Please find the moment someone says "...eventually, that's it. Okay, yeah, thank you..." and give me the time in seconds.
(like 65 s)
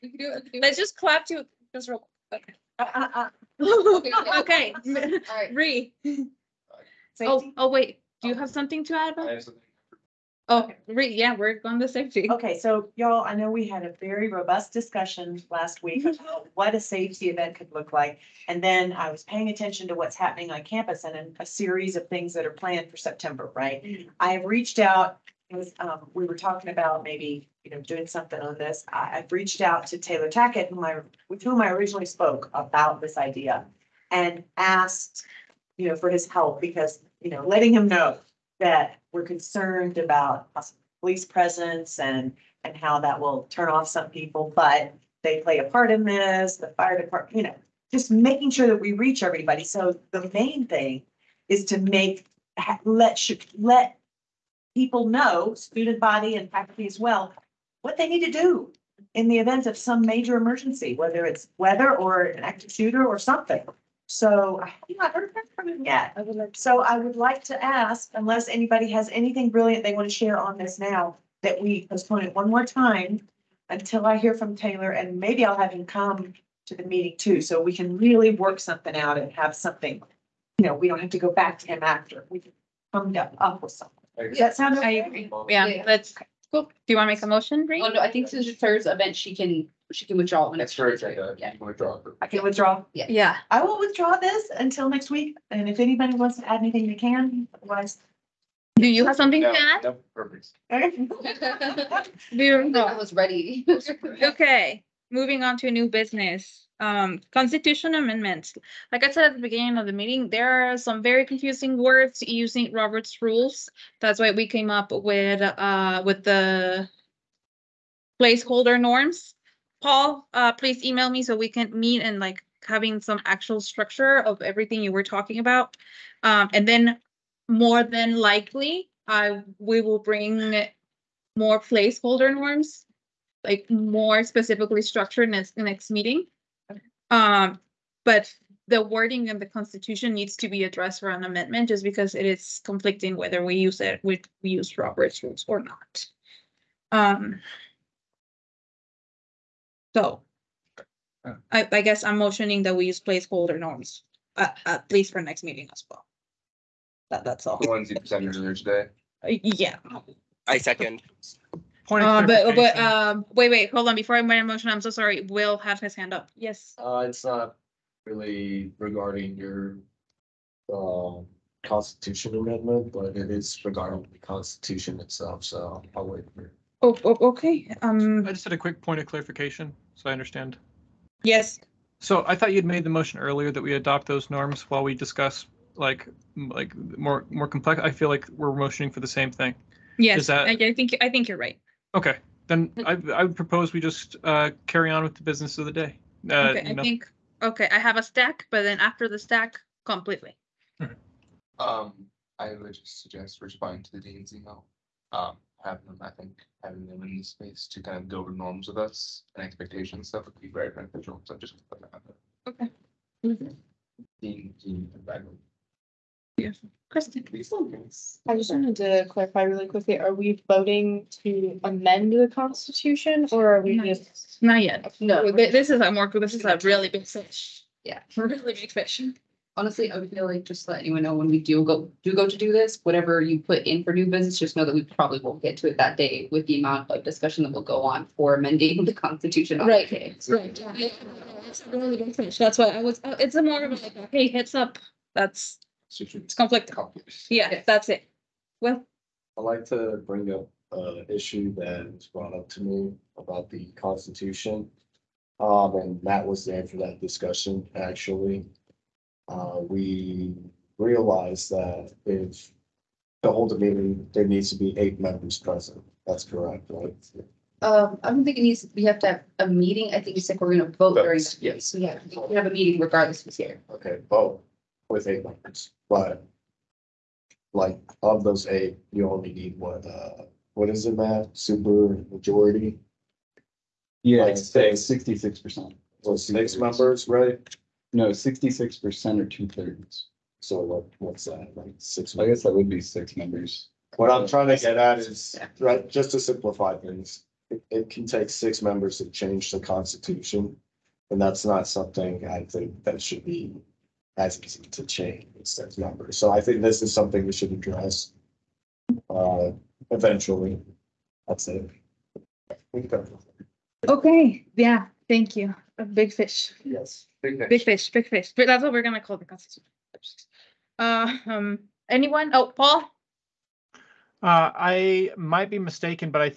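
309 s.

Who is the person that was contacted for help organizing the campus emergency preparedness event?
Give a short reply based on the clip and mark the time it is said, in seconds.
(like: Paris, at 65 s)
Taylor Tackett, at 29 s.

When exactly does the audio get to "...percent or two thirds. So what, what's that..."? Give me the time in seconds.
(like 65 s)
288 s.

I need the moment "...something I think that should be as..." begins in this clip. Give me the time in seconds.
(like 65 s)
301 s.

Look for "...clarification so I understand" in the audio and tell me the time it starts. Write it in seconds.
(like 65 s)
179 s.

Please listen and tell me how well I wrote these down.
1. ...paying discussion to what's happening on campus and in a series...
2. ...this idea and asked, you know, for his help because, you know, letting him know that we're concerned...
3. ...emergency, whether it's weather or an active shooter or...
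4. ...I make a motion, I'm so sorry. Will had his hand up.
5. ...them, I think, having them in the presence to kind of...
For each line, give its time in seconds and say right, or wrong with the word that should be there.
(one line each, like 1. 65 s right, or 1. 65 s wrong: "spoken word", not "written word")
1. 19 s wrong: "attention", not "discussion"
2. 33 s right
3. 60 s right
4. 164 s right
5. 205 s wrong: "space", not "presence".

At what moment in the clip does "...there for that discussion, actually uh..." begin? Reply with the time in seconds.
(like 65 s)
256 s.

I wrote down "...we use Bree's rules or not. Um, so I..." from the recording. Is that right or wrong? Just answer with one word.
wrong.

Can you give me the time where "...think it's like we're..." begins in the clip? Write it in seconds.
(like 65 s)
269 s.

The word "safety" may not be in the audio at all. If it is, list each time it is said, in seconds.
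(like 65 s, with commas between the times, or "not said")
11 s, 16 s.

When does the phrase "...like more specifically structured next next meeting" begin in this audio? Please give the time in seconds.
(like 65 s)
133 s.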